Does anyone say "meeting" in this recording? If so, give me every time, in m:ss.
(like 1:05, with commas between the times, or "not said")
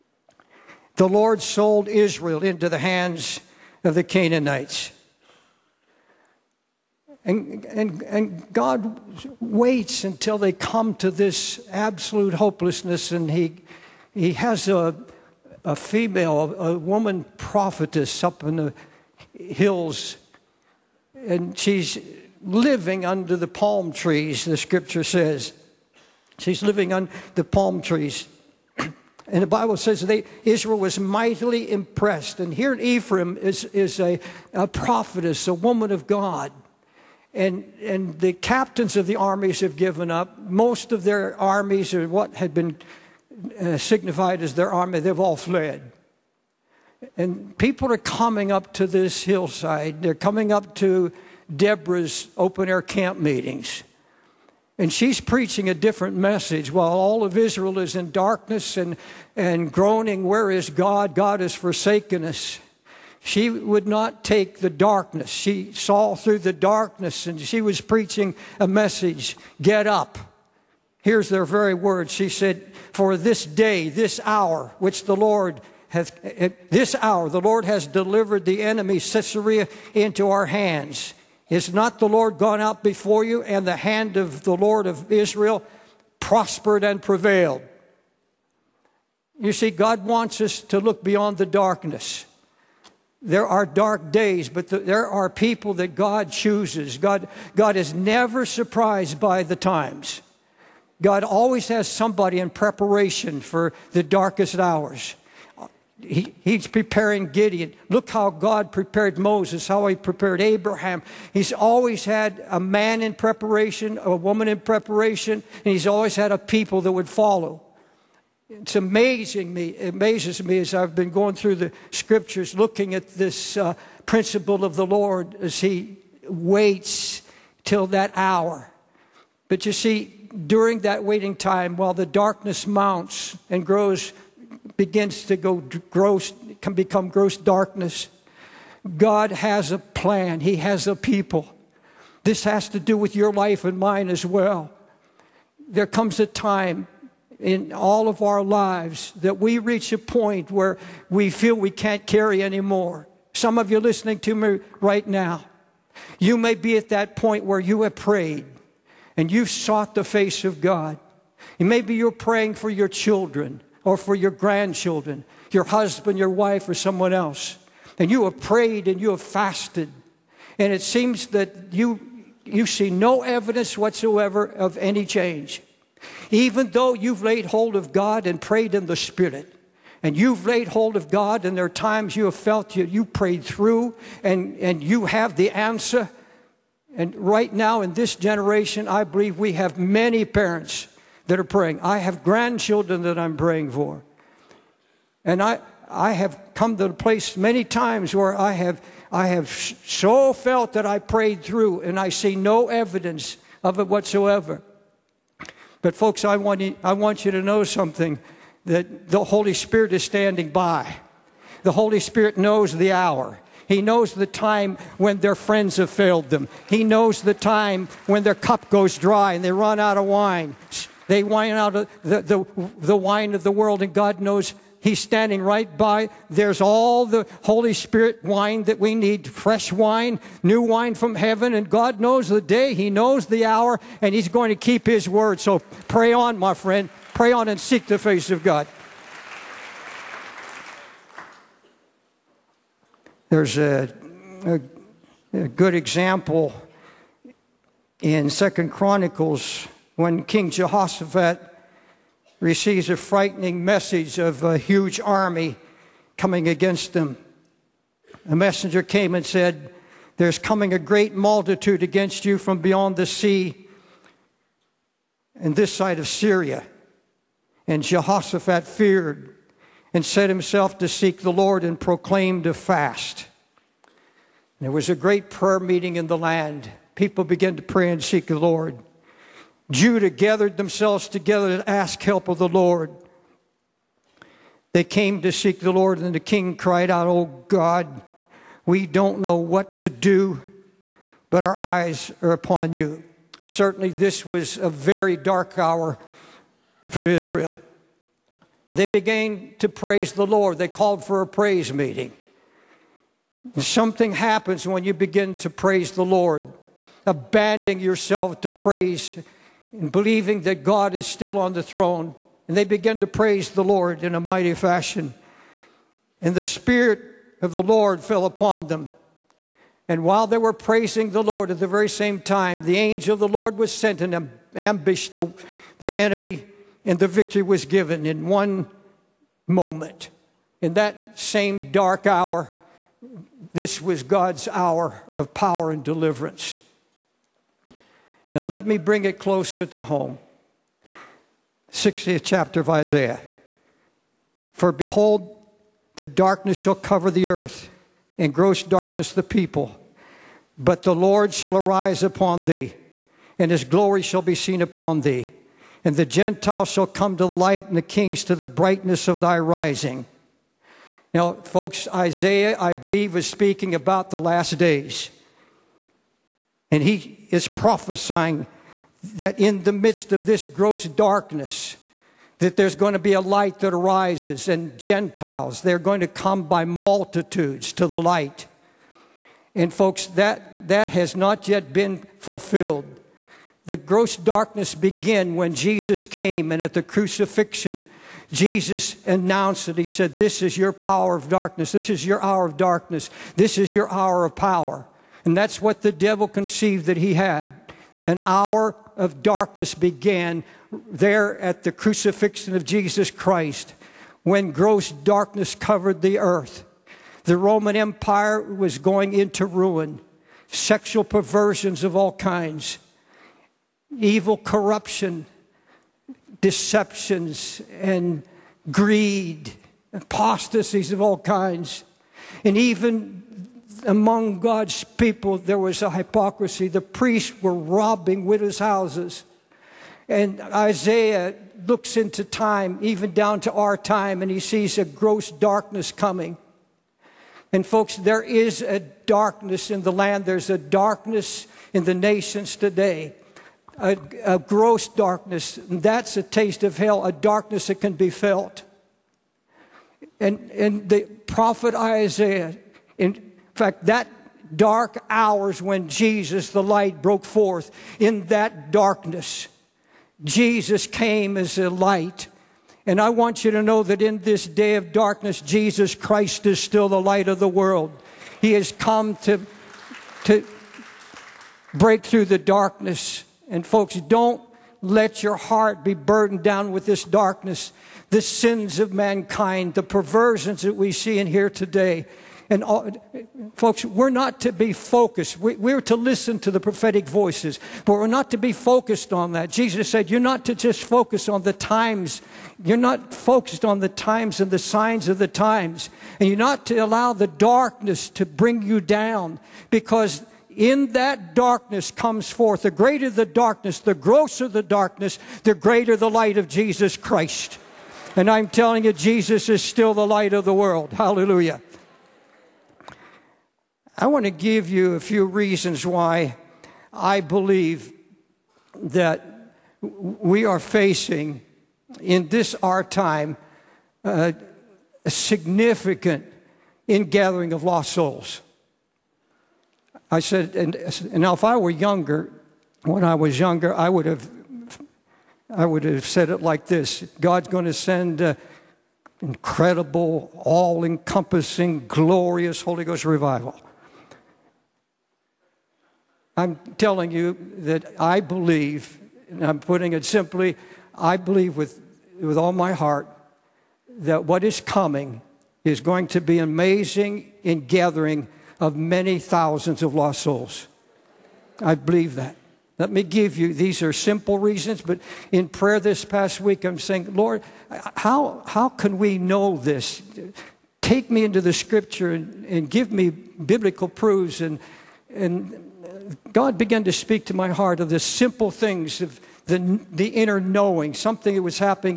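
0:53, 4:35, 5:01.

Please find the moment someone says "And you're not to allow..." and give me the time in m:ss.
8:16.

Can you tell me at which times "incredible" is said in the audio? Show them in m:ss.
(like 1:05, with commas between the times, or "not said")
8:59.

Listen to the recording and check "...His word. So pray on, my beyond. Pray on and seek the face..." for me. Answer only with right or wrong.
wrong.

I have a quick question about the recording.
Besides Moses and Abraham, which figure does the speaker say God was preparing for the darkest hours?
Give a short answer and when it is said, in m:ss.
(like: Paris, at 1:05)
Gideon, at 1:47.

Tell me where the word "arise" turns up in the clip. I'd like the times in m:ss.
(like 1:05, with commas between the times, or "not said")
5:51, 6:13.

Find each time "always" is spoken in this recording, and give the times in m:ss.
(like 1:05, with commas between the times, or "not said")
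1:41, 1:51, 1:55.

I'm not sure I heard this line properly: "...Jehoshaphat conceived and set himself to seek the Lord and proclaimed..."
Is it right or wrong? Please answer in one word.
wrong.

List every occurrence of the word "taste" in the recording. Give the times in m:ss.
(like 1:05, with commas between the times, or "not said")
7:26.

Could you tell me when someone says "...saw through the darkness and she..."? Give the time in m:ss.
1:05.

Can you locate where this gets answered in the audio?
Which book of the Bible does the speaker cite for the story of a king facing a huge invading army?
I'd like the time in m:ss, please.
4:08.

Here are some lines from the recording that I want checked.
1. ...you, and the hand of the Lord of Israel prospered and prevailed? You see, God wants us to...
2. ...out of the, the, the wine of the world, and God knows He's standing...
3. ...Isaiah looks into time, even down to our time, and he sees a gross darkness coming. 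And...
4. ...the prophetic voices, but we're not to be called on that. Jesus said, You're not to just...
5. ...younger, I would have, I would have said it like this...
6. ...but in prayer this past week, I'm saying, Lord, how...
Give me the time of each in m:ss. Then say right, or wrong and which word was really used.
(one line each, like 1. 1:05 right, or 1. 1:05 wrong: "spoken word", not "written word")
1. 1:23 right
2. 3:41 right
3. 7:10 right
4. 8:06 wrong: "focused", not "called"
5. 8:53 right
6. 9:24 right.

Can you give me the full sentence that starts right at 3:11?
I have grandchildren that I'm praying for.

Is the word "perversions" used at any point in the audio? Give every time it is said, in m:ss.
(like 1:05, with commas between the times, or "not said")
6:51, 7:59.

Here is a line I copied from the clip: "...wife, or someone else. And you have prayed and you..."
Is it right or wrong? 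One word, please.
right.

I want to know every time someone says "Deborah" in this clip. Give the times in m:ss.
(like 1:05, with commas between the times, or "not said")
0:51.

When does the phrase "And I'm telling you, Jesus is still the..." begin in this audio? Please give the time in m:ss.
8:28.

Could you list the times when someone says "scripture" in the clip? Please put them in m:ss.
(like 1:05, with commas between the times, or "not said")
0:24, 2:01, 9:31.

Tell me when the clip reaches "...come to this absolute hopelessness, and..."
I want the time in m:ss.
0:10.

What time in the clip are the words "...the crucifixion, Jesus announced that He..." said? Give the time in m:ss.
6:26.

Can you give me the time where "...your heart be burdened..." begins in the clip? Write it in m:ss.
7:55.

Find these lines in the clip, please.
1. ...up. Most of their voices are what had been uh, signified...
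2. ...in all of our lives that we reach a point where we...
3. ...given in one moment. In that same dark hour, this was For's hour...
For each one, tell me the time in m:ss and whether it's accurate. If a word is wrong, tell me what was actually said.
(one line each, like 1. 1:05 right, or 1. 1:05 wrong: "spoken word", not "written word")
1. 0:40 wrong: "armies", not "voices"
2. 2:27 right
3. 5:27 wrong: "God", not "For".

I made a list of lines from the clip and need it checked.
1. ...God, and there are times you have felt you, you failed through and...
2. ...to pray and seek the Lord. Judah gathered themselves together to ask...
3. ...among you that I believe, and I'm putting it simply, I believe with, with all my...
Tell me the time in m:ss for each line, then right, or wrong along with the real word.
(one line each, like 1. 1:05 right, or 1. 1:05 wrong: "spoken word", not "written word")
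1. 3:01 wrong: "prayed", not "failed"
2. 4:37 right
3. 9:06 wrong: "telling", not "among".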